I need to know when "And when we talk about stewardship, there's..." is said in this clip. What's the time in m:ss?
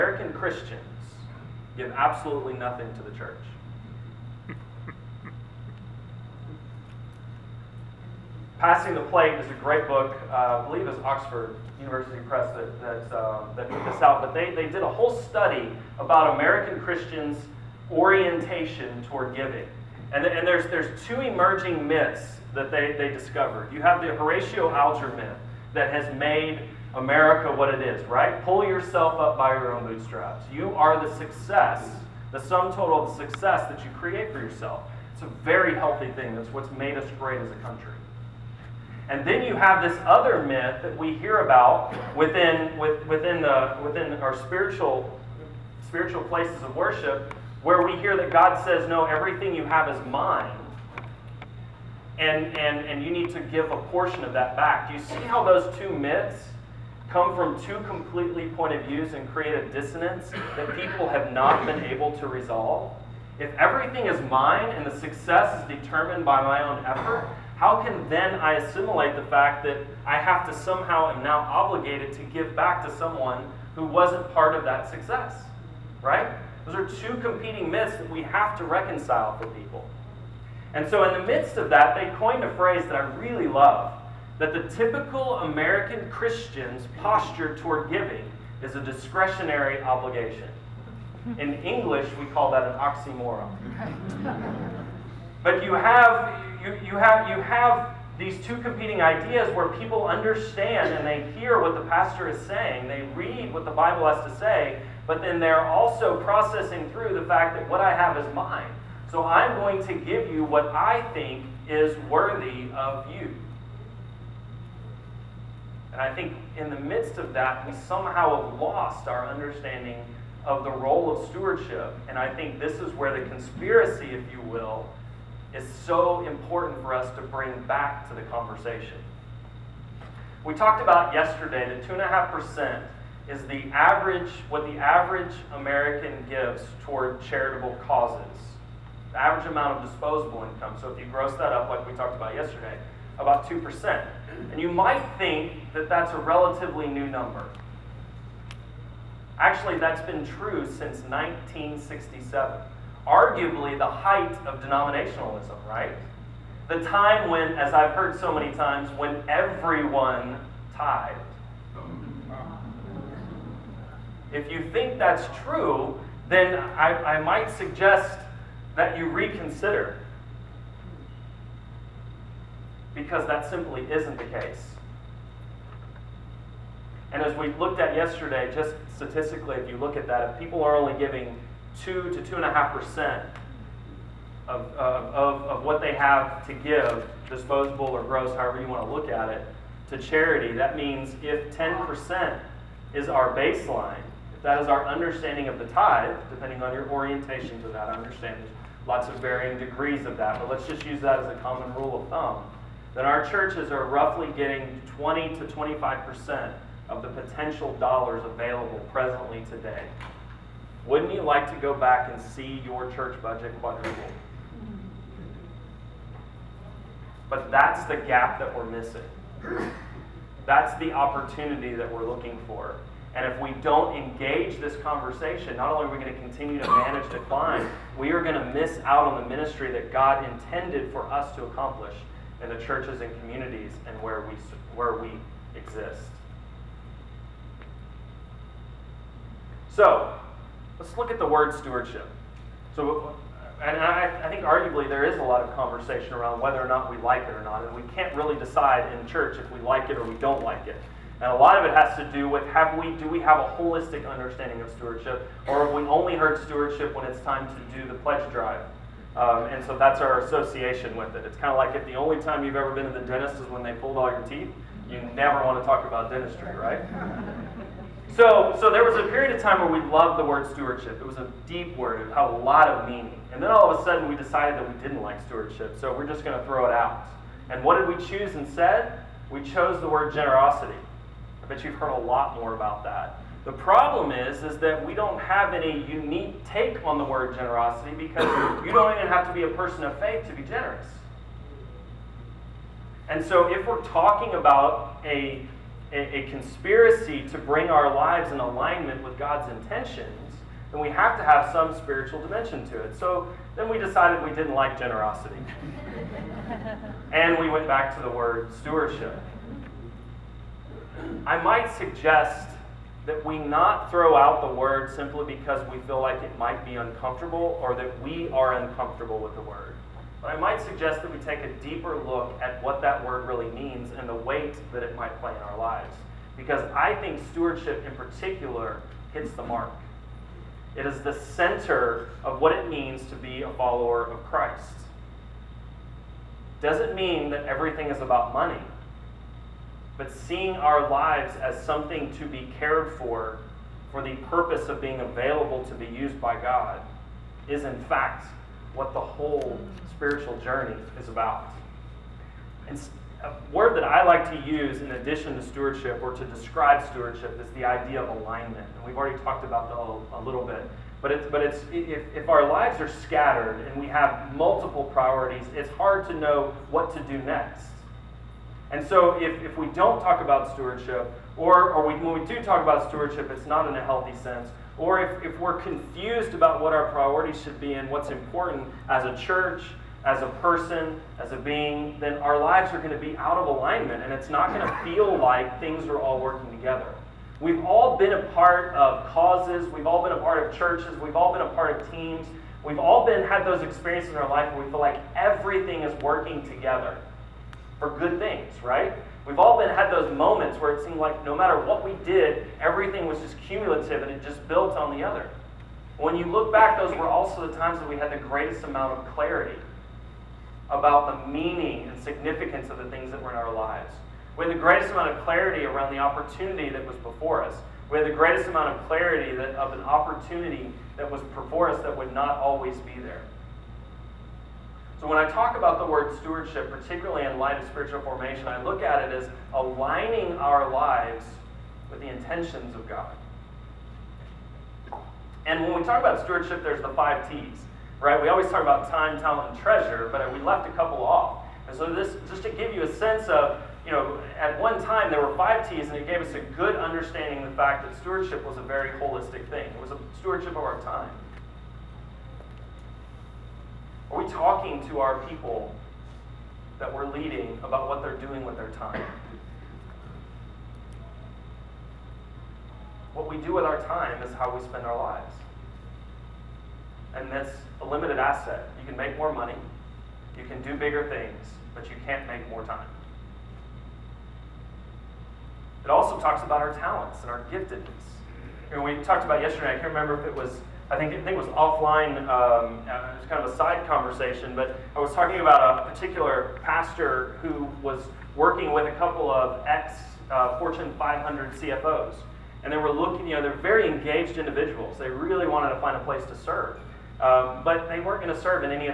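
7:15.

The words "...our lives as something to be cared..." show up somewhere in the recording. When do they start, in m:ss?
5:40.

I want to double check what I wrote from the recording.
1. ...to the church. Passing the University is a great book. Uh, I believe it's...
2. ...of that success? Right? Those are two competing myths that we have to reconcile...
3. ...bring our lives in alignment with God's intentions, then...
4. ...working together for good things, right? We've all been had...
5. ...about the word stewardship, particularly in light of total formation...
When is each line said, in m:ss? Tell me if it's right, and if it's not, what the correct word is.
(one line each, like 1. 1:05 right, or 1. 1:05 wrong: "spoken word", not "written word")
1. 0:02 wrong: "Plate", not "University"
2. 1:14 right
3. 4:57 right
4. 6:36 right
5. 7:05 wrong: "spiritual", not "total".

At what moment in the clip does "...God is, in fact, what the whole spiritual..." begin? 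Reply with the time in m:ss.
5:46.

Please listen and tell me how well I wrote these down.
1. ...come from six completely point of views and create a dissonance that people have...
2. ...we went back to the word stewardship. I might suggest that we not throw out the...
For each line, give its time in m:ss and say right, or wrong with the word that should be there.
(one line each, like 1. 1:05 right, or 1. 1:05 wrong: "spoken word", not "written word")
1. 0:57 wrong: "two", not "six"
2. 5:07 right.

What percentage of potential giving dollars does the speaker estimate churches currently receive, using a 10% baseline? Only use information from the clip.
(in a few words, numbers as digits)
20 to 25%.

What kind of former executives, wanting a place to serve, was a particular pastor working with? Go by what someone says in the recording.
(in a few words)
Fortune 500 CFOs.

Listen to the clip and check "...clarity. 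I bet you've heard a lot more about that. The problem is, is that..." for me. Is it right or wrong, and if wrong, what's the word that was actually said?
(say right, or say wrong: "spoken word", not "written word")
wrong: "generosity", not "clarity".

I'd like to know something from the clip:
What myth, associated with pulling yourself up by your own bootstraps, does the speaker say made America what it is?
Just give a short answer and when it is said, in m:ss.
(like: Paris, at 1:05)
Horatio Alger myth, at 0:24.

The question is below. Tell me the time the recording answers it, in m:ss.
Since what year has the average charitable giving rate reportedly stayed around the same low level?
2:31.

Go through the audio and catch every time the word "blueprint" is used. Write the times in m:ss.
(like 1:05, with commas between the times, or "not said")
not said.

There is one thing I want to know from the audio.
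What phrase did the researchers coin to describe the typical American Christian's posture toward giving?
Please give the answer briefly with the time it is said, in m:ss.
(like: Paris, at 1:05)
discretionary obligation, at 1:28.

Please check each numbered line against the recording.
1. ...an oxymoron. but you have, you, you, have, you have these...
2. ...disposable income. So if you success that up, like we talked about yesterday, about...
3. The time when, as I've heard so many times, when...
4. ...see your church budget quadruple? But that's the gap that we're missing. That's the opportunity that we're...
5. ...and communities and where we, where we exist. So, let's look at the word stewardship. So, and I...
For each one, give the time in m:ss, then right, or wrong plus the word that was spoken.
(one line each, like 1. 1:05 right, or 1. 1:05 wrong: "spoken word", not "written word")
1. 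1:32 right
2. 2:19 wrong: "gross", not "success"
3. 2:36 right
4. 3:32 right
5. 3:53 right.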